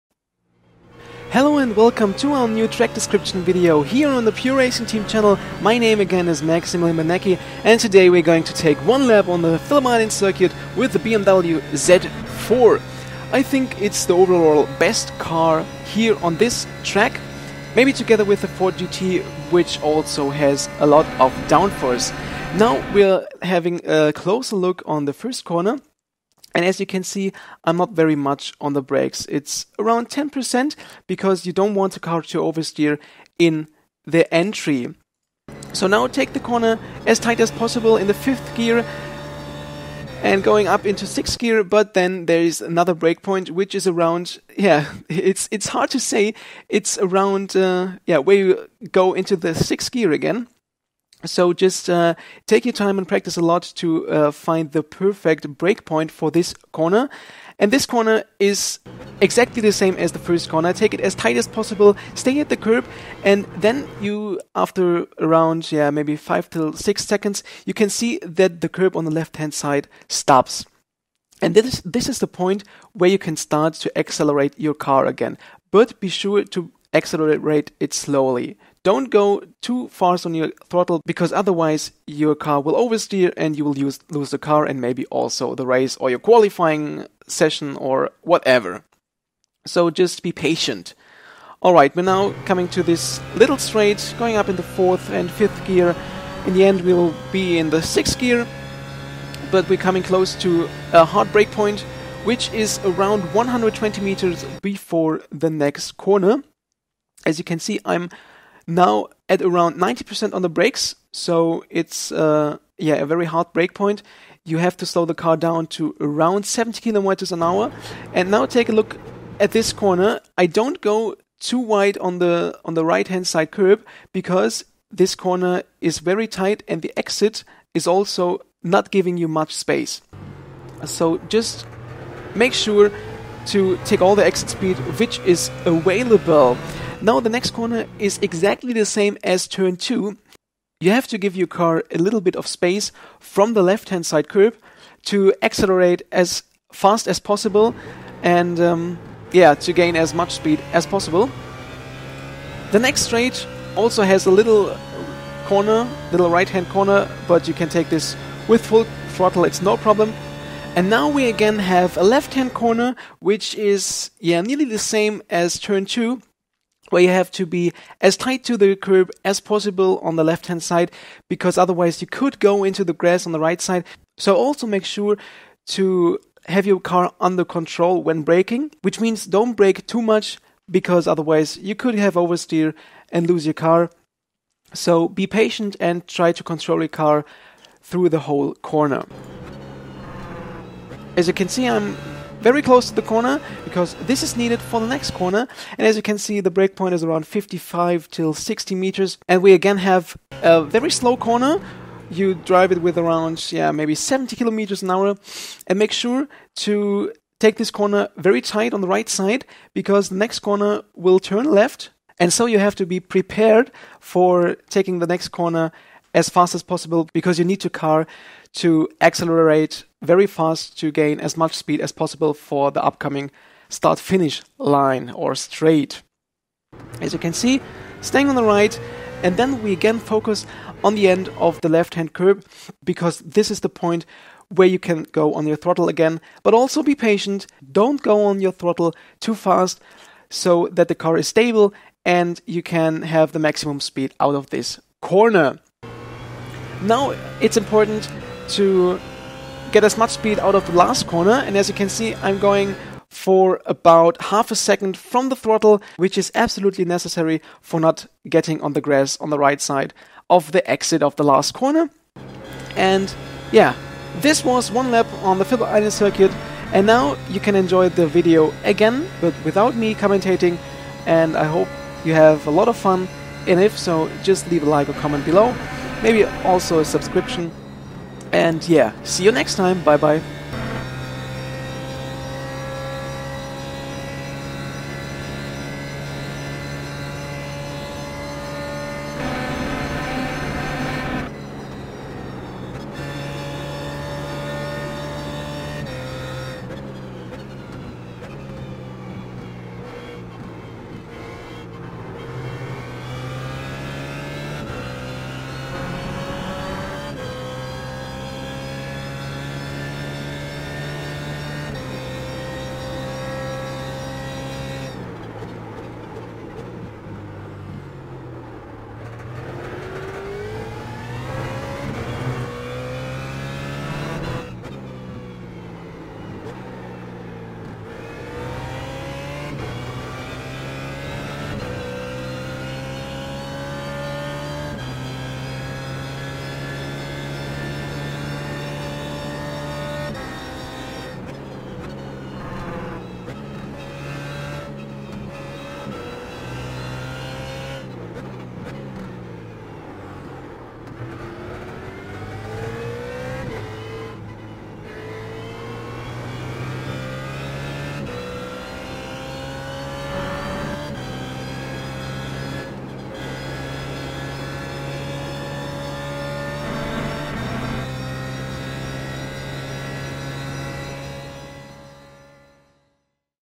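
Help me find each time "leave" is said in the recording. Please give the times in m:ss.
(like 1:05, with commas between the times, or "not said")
4:34.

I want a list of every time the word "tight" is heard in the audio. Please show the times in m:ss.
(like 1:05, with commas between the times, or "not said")
0:37, 1:01, 2:06, 2:48, 3:28.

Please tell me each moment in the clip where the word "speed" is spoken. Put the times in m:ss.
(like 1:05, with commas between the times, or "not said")
2:14, 2:30, 3:41, 4:03, 4:10.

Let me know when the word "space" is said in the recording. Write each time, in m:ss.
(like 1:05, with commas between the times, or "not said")
2:09, 2:22.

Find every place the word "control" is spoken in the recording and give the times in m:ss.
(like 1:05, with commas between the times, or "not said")
2:57, 3:06.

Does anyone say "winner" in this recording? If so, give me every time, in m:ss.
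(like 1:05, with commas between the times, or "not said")
not said.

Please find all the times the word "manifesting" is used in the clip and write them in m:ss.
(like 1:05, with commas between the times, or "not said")
not said.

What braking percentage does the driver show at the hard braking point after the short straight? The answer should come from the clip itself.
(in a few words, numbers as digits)
90%.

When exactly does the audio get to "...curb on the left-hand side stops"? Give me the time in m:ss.
1:08.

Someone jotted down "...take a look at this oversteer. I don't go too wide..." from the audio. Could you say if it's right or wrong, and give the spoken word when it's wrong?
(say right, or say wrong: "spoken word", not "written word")
wrong: "corner", not "oversteer".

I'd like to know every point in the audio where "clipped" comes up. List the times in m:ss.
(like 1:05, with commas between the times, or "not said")
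not said.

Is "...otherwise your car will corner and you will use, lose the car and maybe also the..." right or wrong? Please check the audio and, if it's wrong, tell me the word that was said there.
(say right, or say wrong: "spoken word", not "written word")
wrong: "oversteer", not "corner".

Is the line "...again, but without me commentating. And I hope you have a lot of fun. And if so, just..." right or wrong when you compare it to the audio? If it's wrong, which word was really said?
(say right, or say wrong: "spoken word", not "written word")
right.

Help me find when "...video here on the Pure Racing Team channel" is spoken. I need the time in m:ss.
0:03.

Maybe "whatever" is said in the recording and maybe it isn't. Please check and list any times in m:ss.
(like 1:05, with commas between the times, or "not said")
1:28.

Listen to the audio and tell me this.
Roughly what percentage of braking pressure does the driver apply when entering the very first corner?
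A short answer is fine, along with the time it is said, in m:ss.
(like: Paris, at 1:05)
10%, at 0:30.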